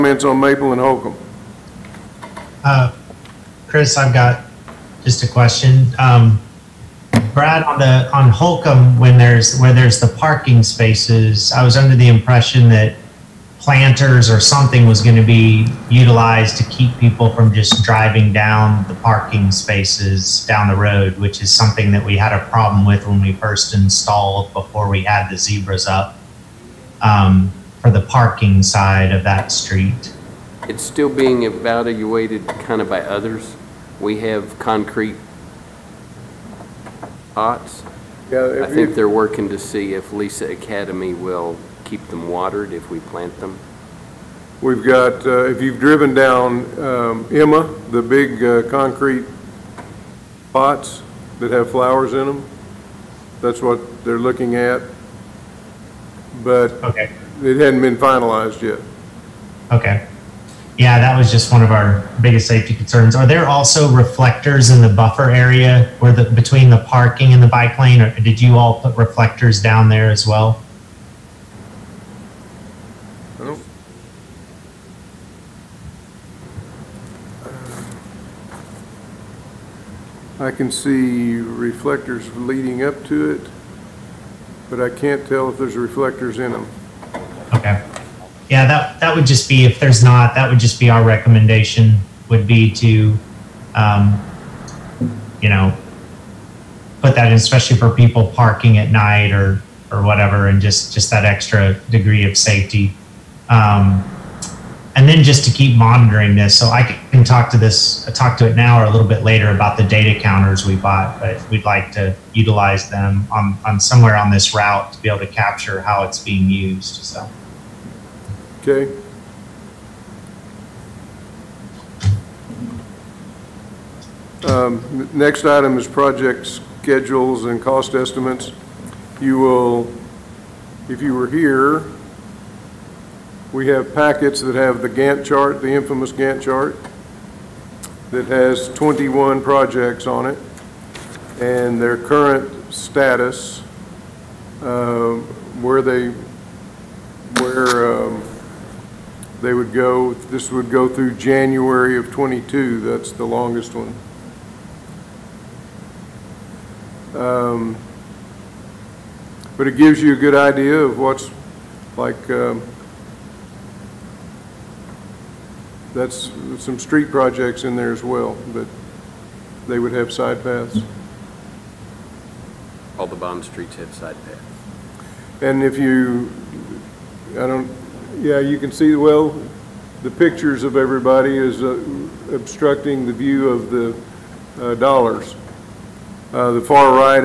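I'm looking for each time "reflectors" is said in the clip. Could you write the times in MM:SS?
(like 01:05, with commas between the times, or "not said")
01:03, 01:08, 01:21, 01:25.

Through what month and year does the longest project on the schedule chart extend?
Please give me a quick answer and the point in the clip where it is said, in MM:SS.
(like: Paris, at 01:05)
January 2022, at 02:31.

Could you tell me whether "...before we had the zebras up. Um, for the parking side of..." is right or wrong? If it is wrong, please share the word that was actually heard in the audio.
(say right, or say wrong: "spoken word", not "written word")
right.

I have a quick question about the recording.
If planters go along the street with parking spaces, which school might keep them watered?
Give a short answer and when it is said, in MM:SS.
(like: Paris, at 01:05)
Lisa Academy, at 00:40.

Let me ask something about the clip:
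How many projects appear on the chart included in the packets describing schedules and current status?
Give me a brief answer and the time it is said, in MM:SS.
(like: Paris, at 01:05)
21, at 02:18.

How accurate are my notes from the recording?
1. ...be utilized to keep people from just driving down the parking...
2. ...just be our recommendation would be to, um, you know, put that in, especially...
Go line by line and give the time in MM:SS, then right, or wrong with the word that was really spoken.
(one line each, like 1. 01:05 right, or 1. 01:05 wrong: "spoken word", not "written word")
1. 00:15 right
2. 01:30 right.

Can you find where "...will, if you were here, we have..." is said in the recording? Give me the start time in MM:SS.
02:09.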